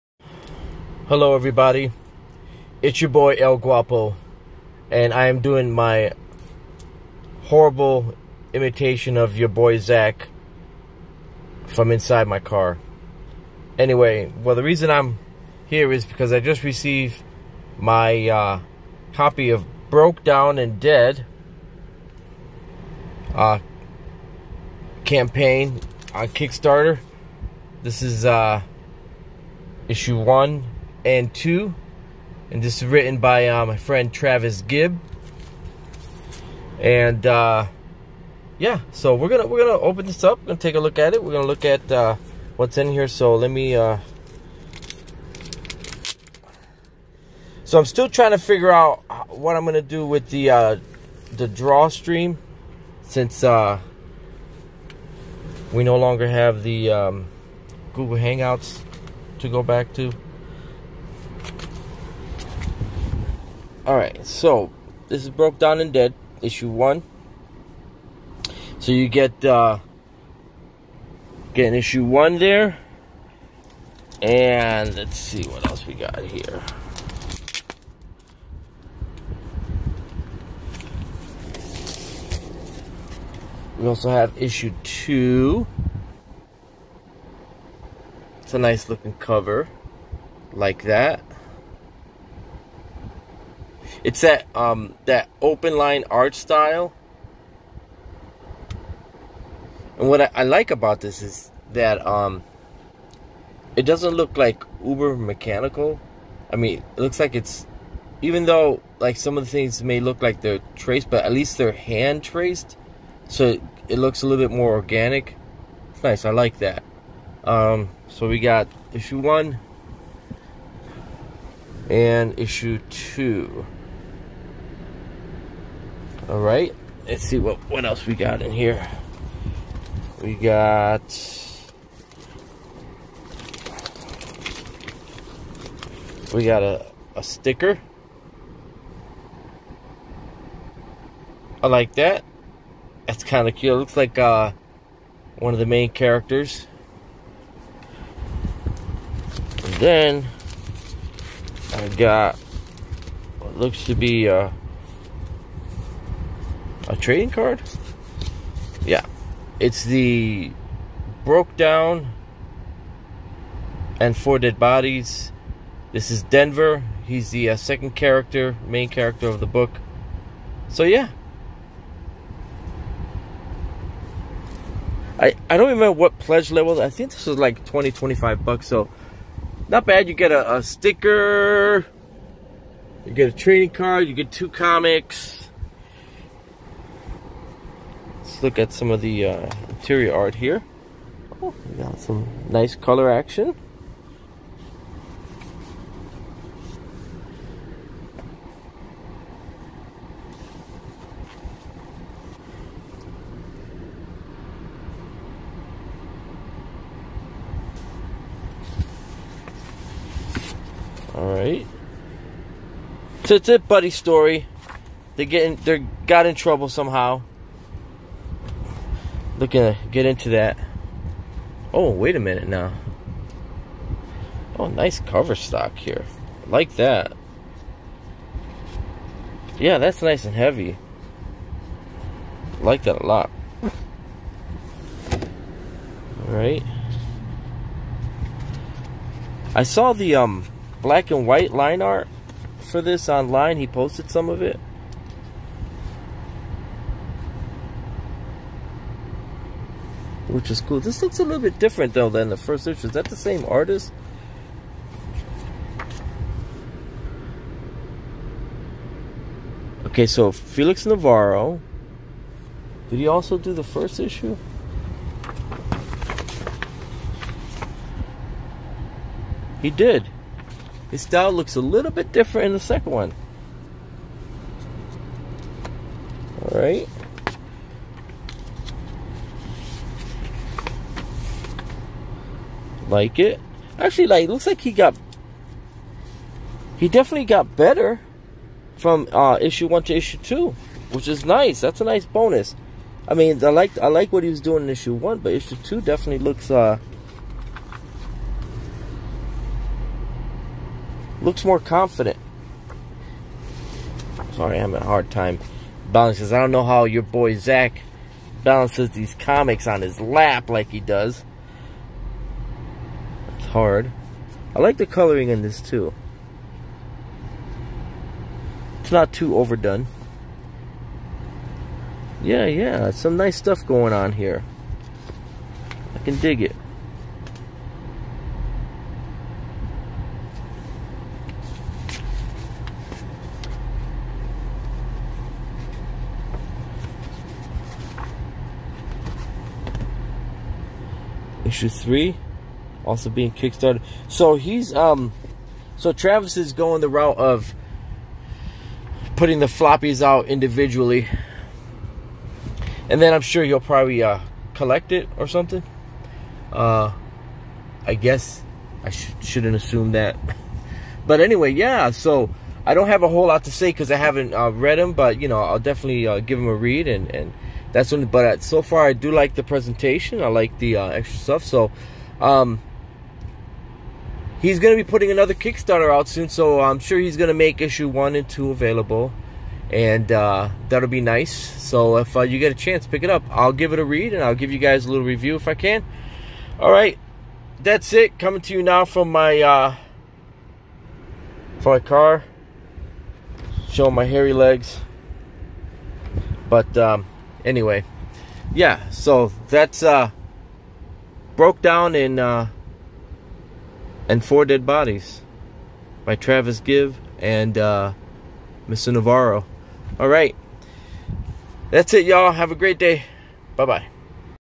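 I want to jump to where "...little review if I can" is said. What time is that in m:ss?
6:24.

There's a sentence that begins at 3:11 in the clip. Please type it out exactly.
we got some nice color action.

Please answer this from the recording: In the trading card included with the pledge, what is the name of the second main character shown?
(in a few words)
Denver.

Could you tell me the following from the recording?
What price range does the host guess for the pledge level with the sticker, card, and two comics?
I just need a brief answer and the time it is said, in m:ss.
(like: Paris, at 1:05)
20 to 25 dollars, at 2:57.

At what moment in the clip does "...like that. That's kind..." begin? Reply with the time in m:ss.
2:21.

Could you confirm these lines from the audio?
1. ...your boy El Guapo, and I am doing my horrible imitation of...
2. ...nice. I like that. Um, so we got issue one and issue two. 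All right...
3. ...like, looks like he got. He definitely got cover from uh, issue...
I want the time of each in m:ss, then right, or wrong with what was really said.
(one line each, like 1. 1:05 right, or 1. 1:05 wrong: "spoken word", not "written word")
1. 0:03 right
2. 1:56 right
3. 4:44 wrong: "better", not "cover".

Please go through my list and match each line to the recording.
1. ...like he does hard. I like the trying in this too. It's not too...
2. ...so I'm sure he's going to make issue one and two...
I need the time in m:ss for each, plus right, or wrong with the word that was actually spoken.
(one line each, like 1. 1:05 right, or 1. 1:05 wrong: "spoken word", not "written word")
1. 5:10 wrong: "coloring", not "trying"
2. 6:16 right.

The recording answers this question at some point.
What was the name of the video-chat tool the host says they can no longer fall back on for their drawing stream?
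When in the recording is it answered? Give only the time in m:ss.
0:57.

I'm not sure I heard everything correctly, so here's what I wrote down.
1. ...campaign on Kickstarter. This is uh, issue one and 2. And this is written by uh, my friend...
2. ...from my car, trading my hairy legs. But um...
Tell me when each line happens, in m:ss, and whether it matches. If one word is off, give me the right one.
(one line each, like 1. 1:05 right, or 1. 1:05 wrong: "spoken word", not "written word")
1. 0:25 right
2. 6:31 wrong: "showing", not "trading".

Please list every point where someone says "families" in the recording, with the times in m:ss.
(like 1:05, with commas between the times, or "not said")
not said.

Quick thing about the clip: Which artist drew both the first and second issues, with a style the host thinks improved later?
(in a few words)
Felix Navarro.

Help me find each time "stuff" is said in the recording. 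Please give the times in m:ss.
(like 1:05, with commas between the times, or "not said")
5:23, 6:11.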